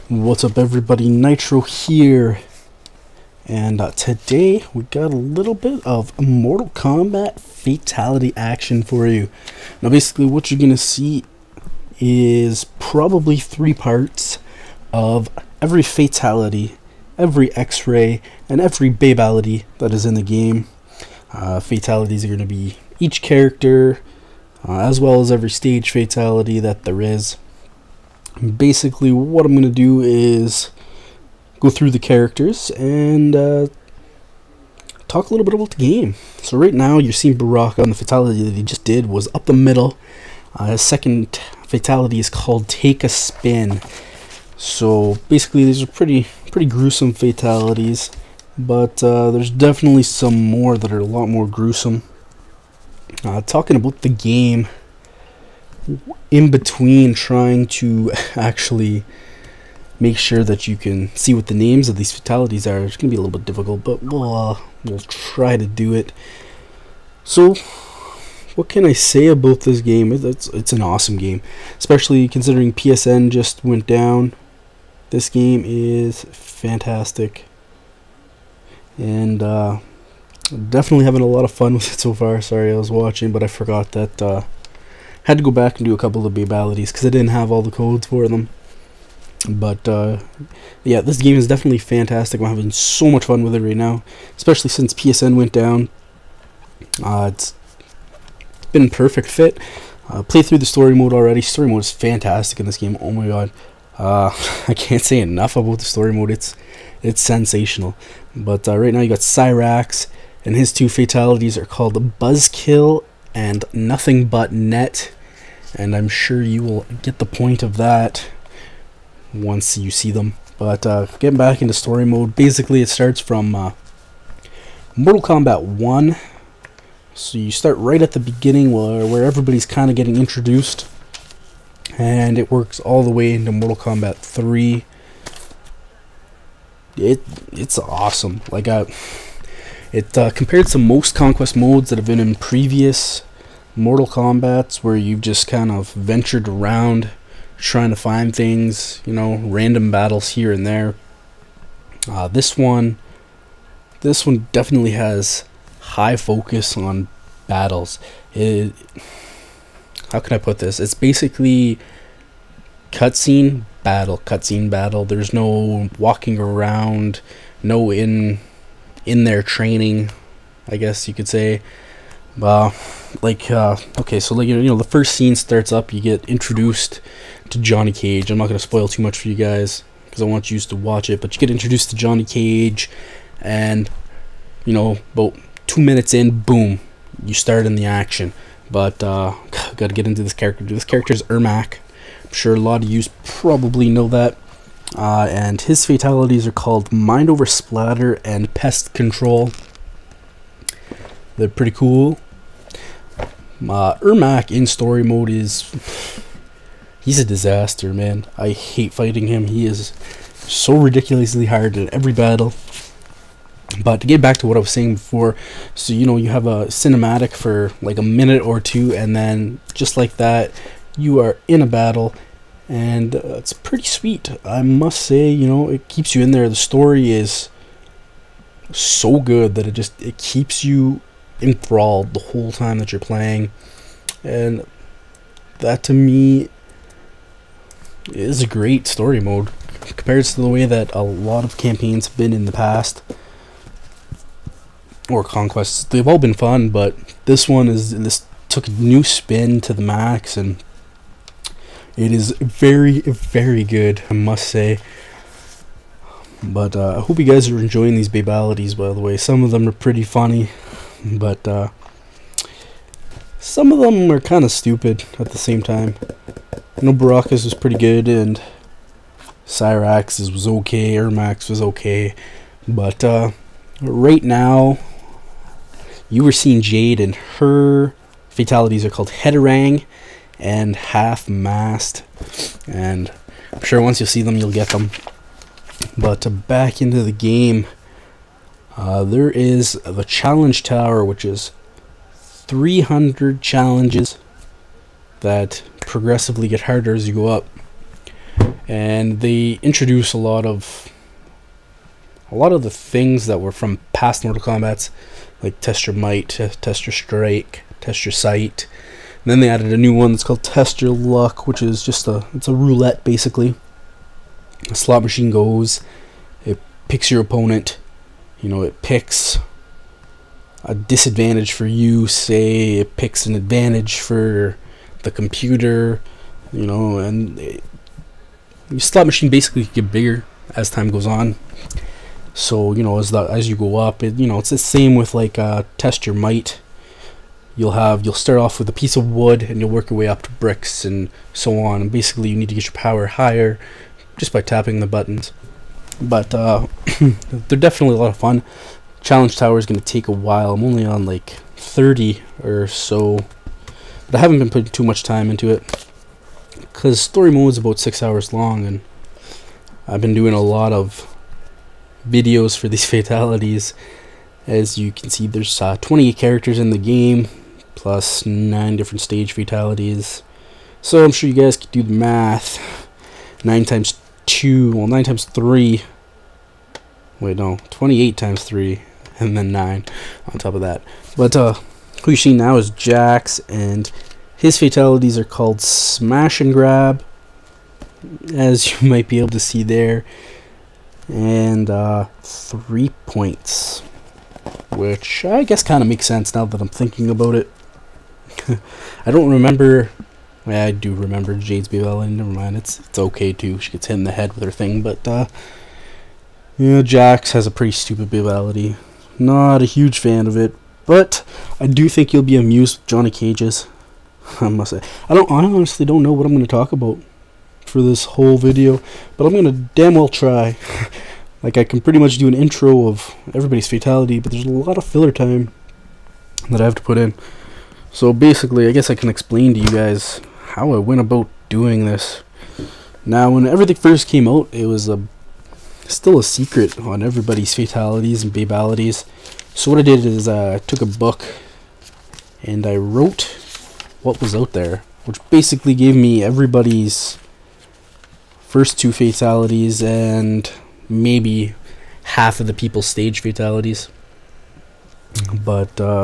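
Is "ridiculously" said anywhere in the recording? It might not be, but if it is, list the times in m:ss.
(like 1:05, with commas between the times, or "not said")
3:30.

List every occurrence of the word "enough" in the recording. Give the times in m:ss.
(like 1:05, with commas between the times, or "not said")
1:45.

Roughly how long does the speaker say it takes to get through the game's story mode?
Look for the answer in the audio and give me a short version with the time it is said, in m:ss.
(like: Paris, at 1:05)
About 6 hours, at 5:57.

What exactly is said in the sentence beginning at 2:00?
But uh, getting back into story mode, basically it starts from uh, Mortal Kombat 1.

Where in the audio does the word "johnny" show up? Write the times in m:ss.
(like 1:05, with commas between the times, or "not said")
2:57, 3:01, 6:52.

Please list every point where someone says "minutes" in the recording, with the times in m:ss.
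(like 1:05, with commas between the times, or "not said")
3:05, 3:38.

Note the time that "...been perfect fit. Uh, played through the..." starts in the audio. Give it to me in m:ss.
1:38.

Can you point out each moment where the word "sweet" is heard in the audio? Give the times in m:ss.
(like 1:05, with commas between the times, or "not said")
3:43.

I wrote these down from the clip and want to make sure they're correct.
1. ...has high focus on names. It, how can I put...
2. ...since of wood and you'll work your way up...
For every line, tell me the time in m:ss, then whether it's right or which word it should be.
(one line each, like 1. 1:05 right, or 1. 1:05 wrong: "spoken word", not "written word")
1. 2:34 wrong: "battles", not "names"
2. 5:38 wrong: "piece", not "since".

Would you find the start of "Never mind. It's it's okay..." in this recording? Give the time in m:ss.
6:42.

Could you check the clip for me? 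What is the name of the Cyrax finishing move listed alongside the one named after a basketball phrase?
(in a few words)
Buzzkill.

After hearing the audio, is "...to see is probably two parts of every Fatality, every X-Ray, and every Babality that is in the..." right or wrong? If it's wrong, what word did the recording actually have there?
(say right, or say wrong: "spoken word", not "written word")
wrong: "three", not "two".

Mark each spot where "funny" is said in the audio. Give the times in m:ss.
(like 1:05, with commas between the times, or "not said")
4:20.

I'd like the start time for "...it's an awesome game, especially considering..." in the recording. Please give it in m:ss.
1:10.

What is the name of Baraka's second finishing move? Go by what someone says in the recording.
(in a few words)
Take a Spin.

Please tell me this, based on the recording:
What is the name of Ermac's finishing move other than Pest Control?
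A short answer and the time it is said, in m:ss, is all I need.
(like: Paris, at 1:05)
Mind Over Splatter, at 3:16.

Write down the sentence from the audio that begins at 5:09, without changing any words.
And then they added a new one that's called test your luck, which is just a it's a roulette basically.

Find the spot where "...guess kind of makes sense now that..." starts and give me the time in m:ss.
6:35.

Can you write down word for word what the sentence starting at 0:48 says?
But uh, there's definitely some more that are a lot more gruesome.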